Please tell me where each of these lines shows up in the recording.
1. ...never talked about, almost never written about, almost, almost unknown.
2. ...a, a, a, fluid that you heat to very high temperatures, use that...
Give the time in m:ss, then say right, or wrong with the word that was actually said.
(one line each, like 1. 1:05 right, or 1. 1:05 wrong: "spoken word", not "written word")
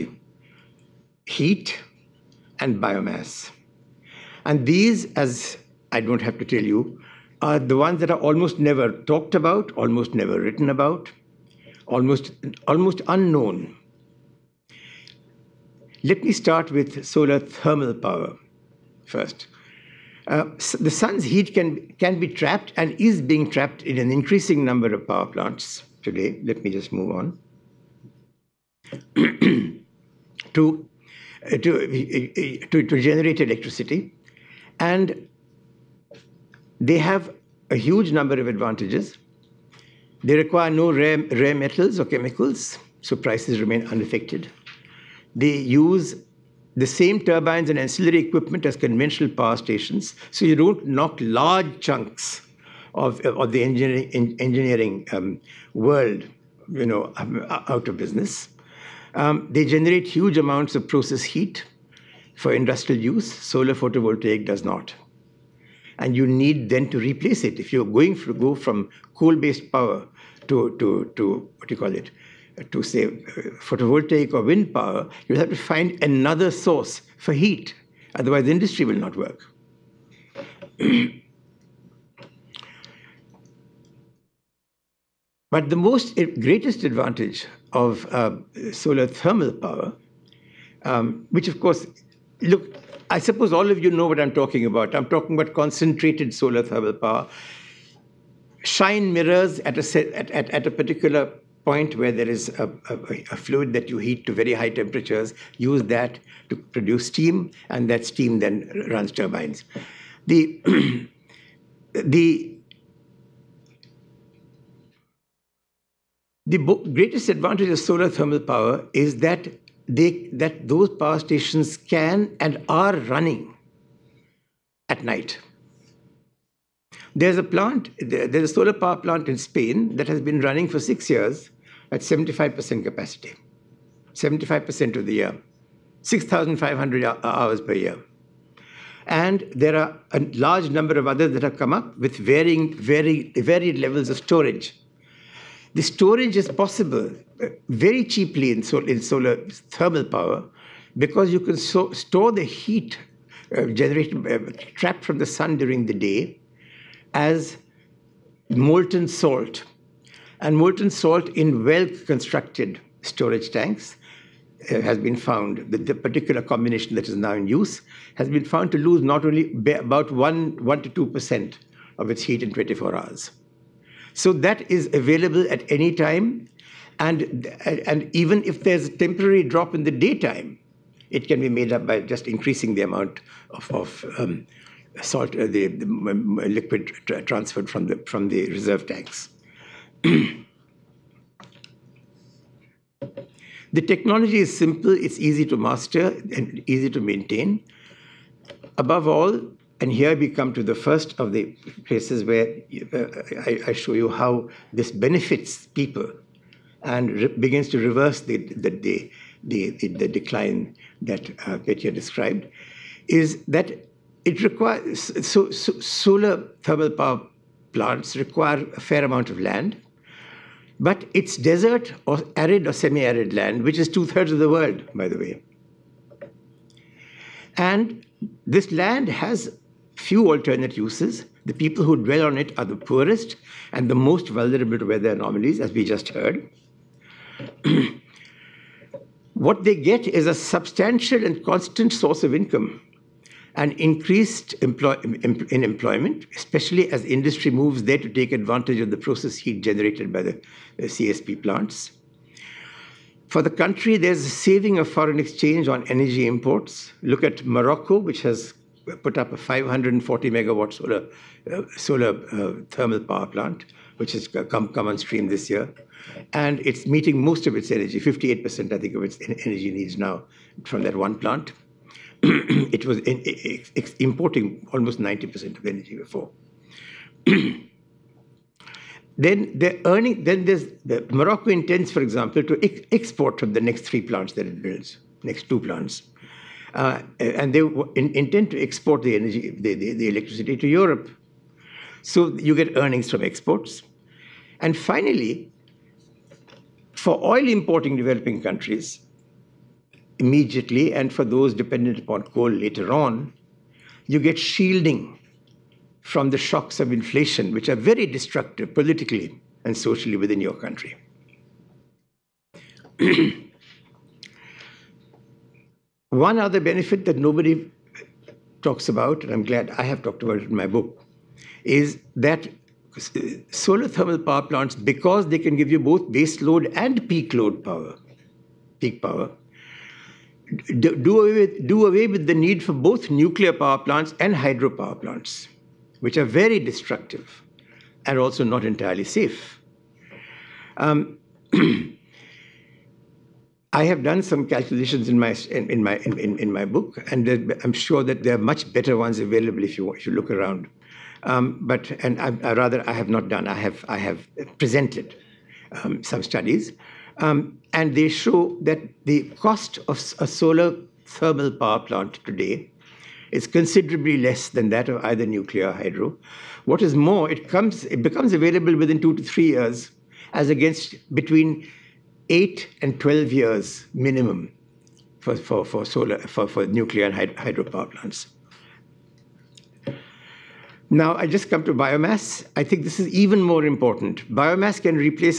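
1. 0:08 right
2. 1:42 right.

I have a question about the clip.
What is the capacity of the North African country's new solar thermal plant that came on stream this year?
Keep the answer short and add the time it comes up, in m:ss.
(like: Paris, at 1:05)
540 megawatts, at 4:19.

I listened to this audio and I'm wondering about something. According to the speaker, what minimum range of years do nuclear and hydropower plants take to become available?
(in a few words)
8 to 12 years.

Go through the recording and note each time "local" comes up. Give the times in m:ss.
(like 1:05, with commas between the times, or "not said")
not said.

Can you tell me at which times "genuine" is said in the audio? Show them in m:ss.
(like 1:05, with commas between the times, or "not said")
not said.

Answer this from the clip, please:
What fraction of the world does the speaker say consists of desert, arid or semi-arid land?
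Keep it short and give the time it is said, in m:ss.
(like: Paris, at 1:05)
Two-thirds, at 3:43.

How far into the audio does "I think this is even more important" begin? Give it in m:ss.
6:22.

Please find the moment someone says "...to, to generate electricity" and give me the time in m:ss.
0:32.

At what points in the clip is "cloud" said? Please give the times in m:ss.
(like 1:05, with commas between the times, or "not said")
not said.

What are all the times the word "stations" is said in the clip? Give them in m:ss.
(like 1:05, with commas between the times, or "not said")
0:49, 2:01.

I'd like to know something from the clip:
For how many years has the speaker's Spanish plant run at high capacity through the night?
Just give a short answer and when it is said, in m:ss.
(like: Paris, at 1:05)
6, at 2:10.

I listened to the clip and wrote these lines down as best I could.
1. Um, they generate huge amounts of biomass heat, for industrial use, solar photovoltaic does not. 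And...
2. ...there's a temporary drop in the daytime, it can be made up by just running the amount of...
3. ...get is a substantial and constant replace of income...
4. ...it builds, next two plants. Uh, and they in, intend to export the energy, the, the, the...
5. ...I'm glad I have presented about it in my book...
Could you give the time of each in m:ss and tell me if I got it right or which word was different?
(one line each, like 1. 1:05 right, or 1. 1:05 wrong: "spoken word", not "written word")
1. 0:59 wrong: "process", not "biomass"
2. 2:58 wrong: "increasing", not "running"
3. 3:59 wrong: "source", not "replace"
4. 4:44 right
5. 5:19 wrong: "talked", not "presented".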